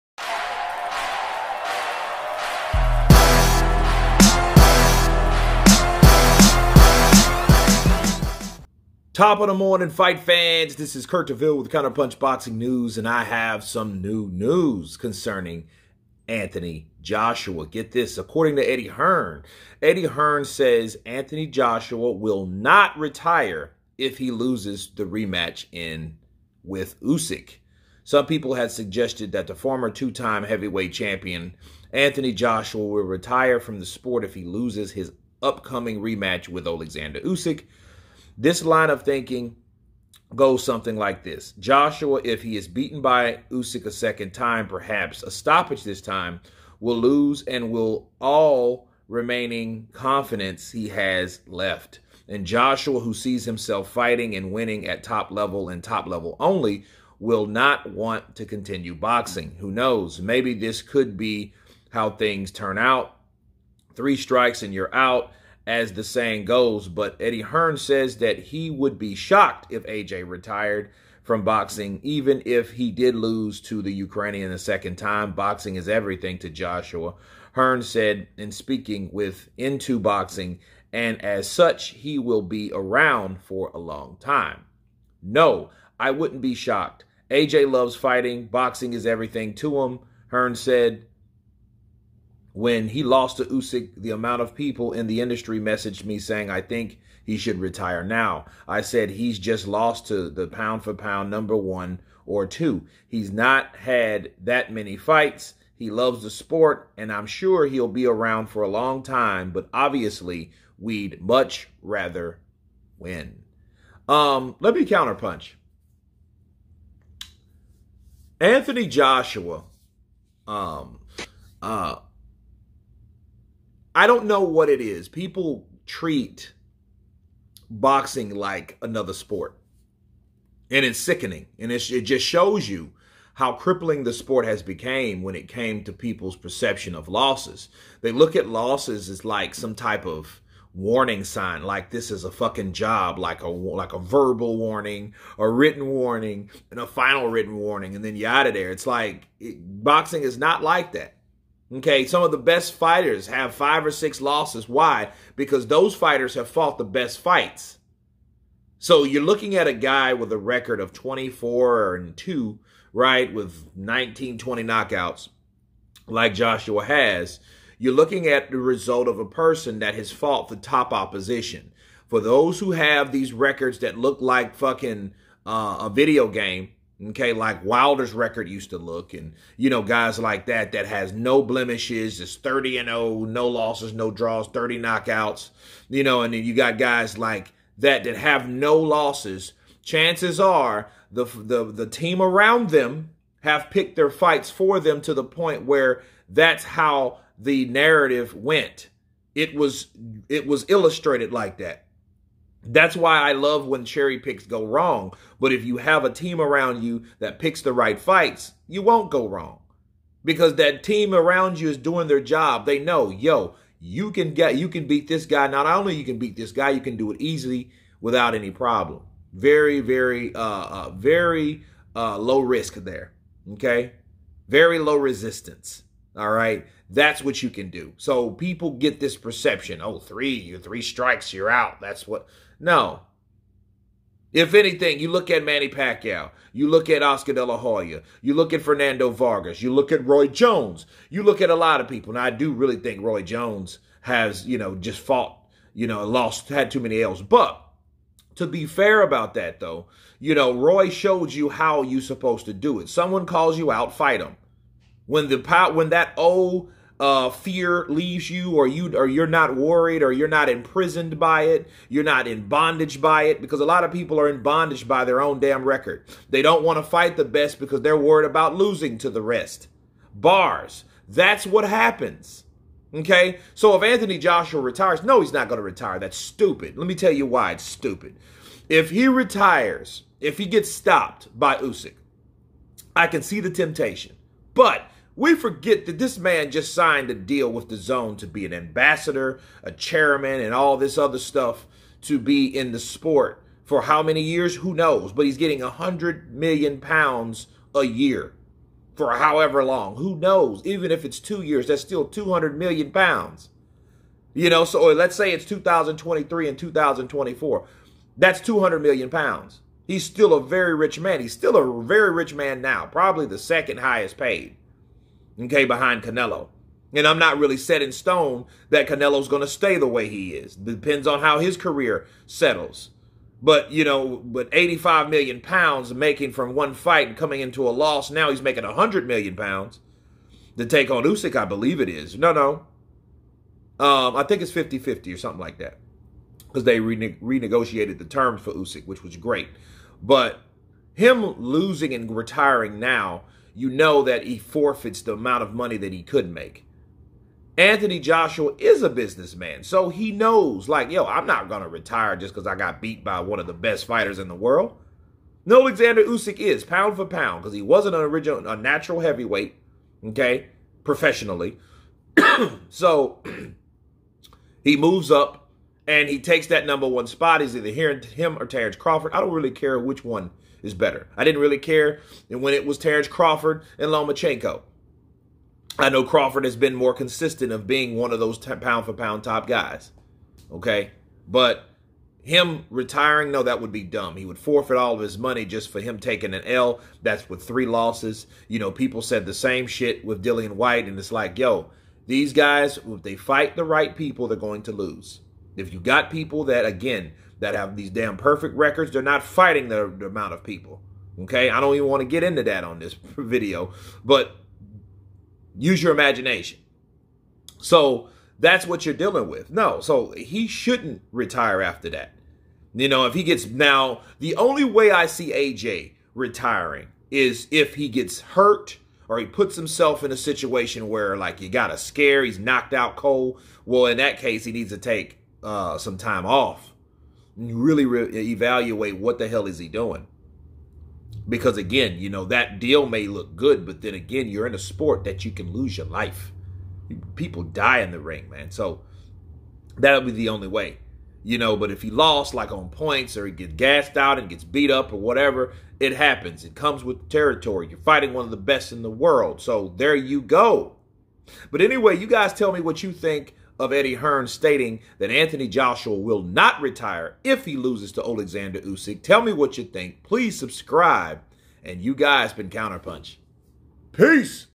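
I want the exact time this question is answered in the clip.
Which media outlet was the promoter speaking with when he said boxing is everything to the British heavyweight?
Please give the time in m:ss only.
1:19.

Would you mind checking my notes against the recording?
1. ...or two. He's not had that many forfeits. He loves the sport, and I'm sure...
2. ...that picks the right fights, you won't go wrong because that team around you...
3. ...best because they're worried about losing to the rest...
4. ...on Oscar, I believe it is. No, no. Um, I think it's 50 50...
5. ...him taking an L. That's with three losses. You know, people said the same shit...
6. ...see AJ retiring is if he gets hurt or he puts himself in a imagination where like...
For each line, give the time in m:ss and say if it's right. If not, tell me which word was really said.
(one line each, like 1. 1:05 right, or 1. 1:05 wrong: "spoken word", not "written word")
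1. 1:42 wrong: "fights", not "forfeits"
2. 3:27 right
3. 4:27 right
4. 5:30 wrong: "Usyk", not "Oscar"
5. 6:25 right
6. 6:55 wrong: "situation", not "imagination".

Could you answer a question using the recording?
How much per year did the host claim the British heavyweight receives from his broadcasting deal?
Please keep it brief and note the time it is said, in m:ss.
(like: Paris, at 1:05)
100 million pounds, at 4:55.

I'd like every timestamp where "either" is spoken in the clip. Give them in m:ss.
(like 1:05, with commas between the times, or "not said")
6:07.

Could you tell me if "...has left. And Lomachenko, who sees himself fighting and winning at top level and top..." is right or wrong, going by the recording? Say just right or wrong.
wrong.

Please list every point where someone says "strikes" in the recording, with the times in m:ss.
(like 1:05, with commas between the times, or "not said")
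1:04, 3:50.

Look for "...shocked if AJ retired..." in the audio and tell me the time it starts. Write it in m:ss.
1:09.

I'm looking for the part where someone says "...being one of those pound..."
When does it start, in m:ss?
6:17.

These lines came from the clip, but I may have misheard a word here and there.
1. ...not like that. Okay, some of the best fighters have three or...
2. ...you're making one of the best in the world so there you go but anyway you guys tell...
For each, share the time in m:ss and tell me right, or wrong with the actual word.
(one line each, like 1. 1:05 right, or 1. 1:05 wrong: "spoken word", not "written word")
1. 2:30 wrong: "five", not "three"
2. 7:27 wrong: "fighting", not "making".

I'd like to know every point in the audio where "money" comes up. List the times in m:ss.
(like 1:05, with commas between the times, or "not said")
5:45, 6:25.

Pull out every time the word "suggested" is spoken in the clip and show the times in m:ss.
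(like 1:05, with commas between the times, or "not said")
0:28.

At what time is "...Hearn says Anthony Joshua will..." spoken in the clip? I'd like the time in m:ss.
0:20.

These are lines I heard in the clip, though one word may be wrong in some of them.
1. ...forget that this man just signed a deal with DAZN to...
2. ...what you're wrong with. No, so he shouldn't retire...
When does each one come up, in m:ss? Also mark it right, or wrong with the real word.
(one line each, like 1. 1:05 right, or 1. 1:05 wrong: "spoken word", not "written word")
1. 4:45 right
2. 6:48 wrong: "dealing", not "wrong".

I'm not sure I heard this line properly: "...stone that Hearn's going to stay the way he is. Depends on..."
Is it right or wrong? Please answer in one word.
wrong.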